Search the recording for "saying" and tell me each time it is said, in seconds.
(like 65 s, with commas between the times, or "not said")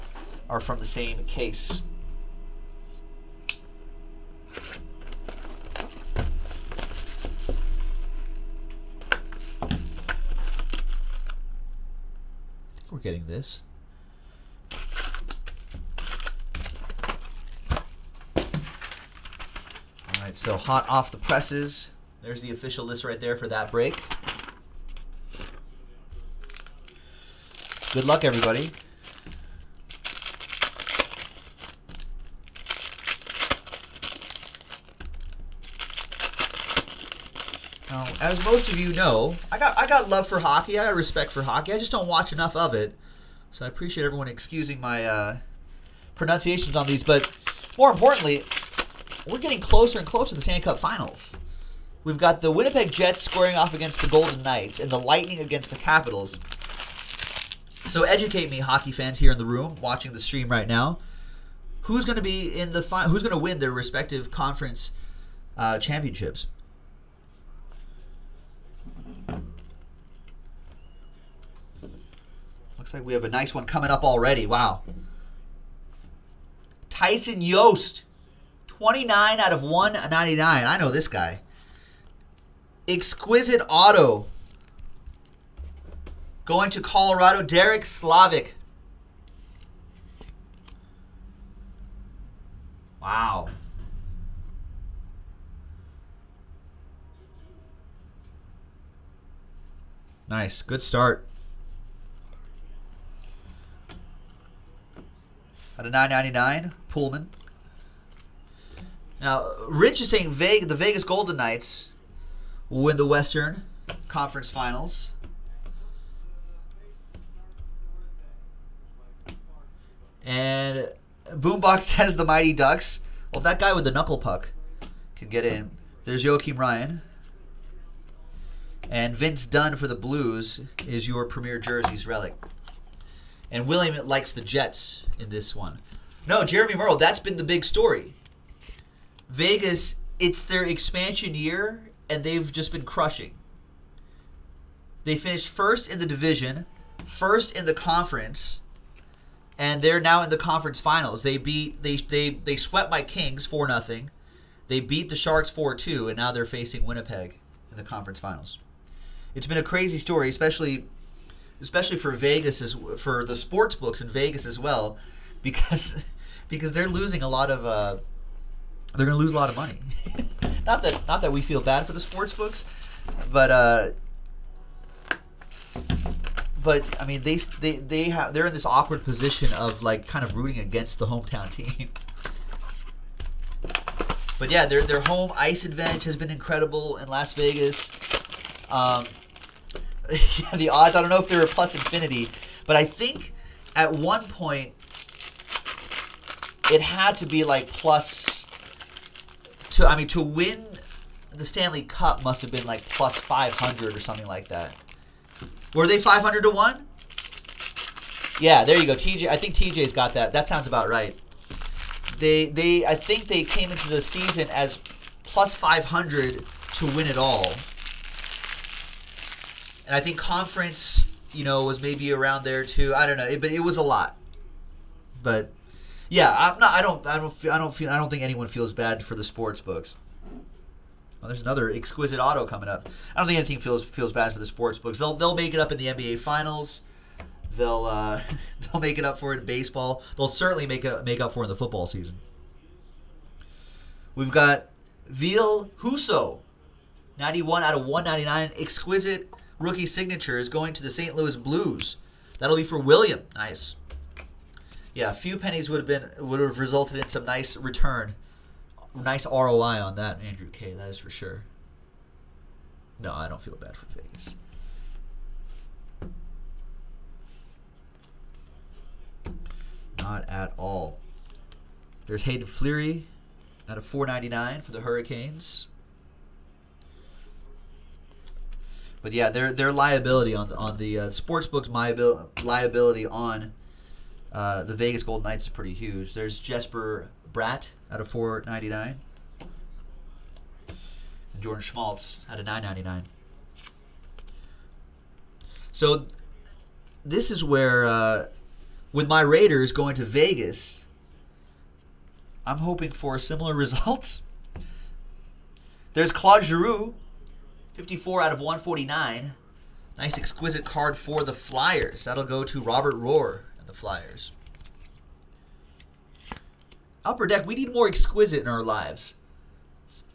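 110 s.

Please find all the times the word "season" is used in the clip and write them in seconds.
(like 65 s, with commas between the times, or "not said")
214 s, 241 s.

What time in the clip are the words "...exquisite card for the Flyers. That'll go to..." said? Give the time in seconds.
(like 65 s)
310 s.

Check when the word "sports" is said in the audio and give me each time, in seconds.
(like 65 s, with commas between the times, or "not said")
163 s, 171 s, 229 s, 234 s, 281 s.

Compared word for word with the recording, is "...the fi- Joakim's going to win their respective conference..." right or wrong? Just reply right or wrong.
wrong.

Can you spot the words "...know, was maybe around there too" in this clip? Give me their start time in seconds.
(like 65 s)
221 s.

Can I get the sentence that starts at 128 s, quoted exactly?
And Vince Dunn for the Blues is your premier jerseys relic.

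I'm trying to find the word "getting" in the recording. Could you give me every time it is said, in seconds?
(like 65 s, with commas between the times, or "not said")
12 s, 49 s.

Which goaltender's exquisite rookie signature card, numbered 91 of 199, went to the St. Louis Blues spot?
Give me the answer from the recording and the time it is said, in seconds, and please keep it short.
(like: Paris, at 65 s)
Ville Husso, at 245 s.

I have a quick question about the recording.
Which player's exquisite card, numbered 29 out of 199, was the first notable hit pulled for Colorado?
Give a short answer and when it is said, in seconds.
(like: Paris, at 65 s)
Tyson Jost, at 76 s.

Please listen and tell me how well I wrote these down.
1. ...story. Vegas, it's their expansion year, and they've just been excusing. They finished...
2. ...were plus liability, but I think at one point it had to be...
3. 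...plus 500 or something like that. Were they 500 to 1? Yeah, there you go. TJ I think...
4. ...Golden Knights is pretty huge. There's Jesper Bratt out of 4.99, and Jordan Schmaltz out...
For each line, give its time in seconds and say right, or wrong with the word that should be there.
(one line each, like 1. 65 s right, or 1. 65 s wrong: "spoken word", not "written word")
1. 137 s wrong: "crushing", not "excusing"
2. 191 s wrong: "infinity", not "liability"
3. 202 s right
4. 285 s right.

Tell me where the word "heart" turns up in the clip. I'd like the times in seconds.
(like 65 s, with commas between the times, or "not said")
not said.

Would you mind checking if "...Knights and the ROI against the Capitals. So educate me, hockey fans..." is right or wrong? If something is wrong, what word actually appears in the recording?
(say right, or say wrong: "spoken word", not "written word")
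wrong: "Lightning", not "ROI".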